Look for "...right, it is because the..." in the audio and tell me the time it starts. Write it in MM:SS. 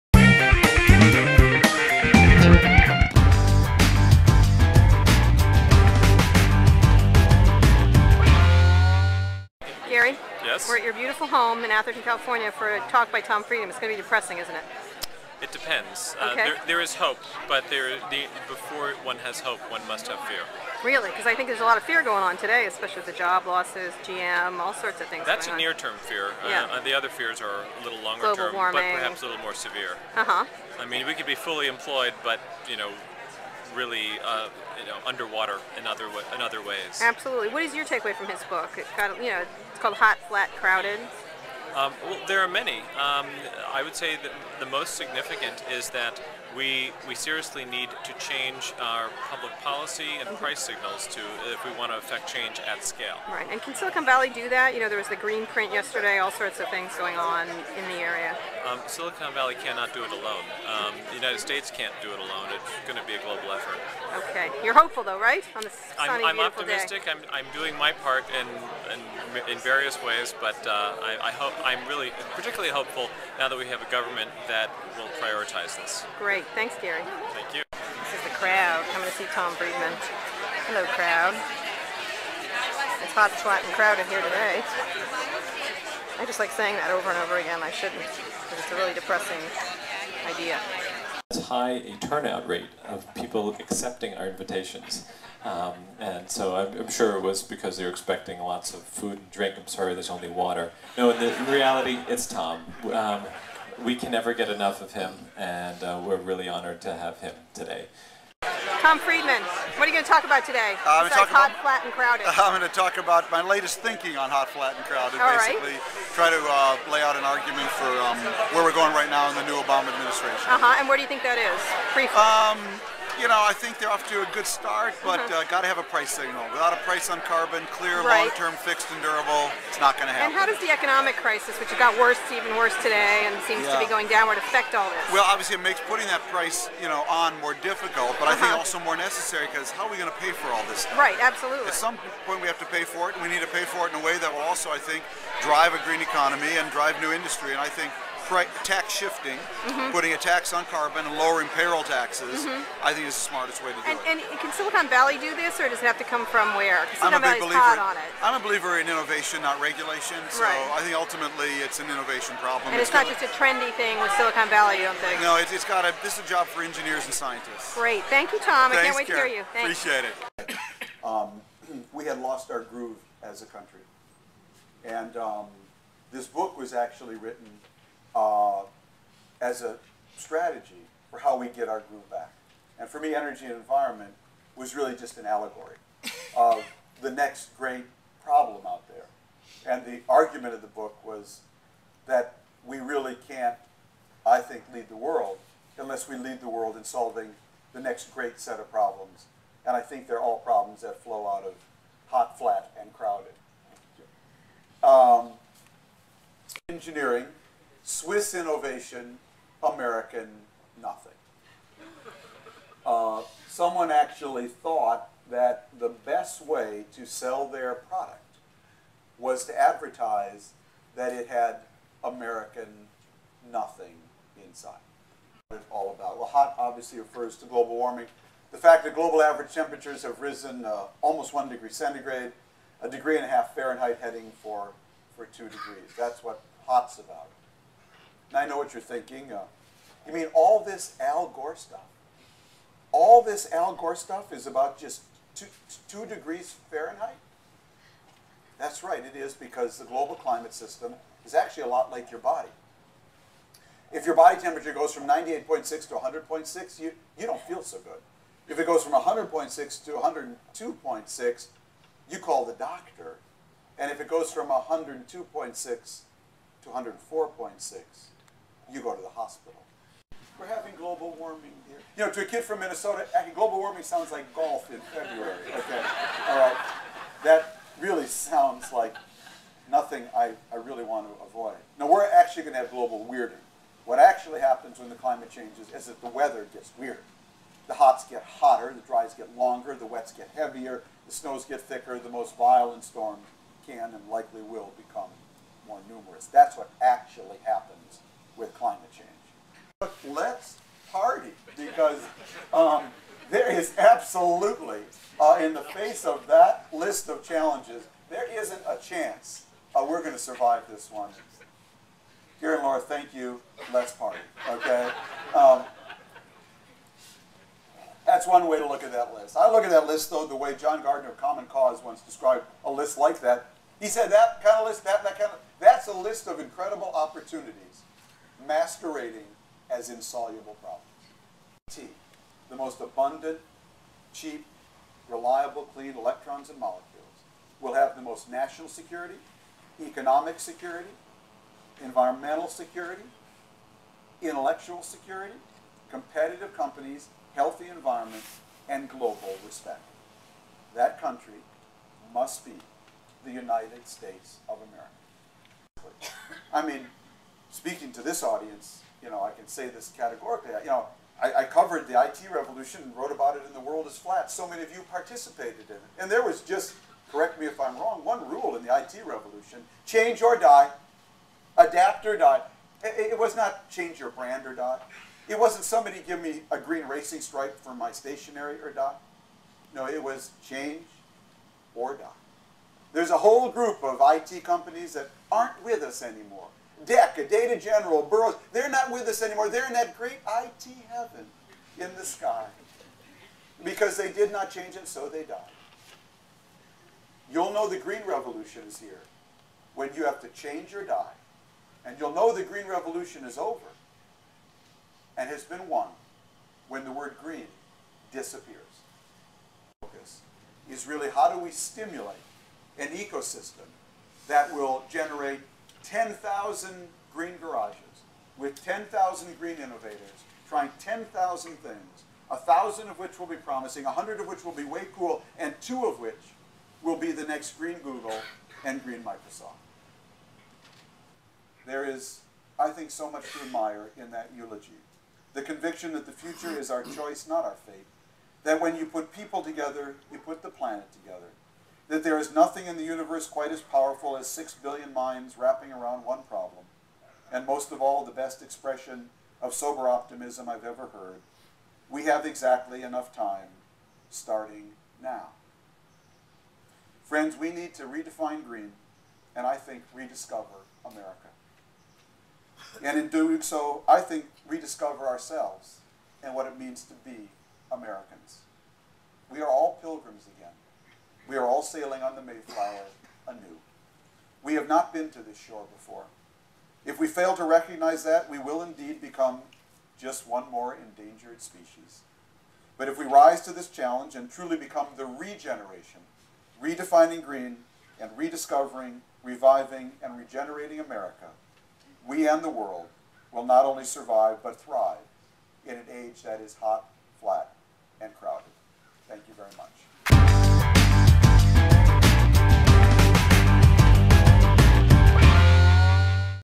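04:08.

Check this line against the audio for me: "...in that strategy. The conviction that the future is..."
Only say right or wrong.
wrong.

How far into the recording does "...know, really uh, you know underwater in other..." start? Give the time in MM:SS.
00:32.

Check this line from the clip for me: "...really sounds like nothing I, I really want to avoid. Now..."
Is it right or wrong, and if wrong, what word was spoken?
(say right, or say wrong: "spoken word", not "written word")
right.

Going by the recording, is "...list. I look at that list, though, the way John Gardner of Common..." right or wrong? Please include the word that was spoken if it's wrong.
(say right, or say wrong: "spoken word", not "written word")
right.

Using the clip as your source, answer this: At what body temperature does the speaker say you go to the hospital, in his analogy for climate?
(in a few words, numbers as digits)
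104.6.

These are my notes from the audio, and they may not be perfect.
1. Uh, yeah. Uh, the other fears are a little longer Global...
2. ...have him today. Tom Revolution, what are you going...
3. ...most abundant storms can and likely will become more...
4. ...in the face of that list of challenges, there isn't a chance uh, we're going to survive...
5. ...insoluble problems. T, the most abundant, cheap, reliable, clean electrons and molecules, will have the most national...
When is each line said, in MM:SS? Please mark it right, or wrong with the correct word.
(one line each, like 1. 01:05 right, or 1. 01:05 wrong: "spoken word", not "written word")
1. 00:26 right
2. 01:46 wrong: "Friedman", not "Revolution"
3. 04:52 wrong: "violent", not "abundant"
4. 05:05 right
5. 05:29 right.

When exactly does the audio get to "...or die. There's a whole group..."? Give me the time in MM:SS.
06:21.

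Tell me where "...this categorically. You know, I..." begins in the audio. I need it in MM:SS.
05:59.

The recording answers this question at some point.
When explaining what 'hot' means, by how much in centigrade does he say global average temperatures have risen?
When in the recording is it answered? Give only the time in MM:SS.
03:51.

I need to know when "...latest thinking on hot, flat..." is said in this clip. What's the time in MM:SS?
01:53.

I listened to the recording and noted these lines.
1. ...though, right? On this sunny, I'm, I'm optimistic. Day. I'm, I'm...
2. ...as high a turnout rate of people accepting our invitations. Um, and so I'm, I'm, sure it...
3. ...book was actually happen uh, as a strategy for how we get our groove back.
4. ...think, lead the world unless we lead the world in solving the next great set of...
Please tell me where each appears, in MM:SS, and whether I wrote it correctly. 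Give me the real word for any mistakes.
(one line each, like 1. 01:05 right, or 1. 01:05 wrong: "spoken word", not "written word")
1. 01:05 right
2. 01:31 right
3. 02:56 wrong: "written", not "happen"
4. 03:14 right.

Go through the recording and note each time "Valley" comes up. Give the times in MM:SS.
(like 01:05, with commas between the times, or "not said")
00:54, 00:59, 02:34, 02:44.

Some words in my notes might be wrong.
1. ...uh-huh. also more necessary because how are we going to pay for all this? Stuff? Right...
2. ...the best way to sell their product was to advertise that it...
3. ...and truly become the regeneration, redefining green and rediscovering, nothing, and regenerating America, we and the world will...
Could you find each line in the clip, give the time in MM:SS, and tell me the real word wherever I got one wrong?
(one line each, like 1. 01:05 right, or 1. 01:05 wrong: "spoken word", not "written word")
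1. 02:18 right
2. 03:35 right
3. 08:04 wrong: "reviving", not "nothing".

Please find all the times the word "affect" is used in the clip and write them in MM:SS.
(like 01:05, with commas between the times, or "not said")
00:52, 02:14.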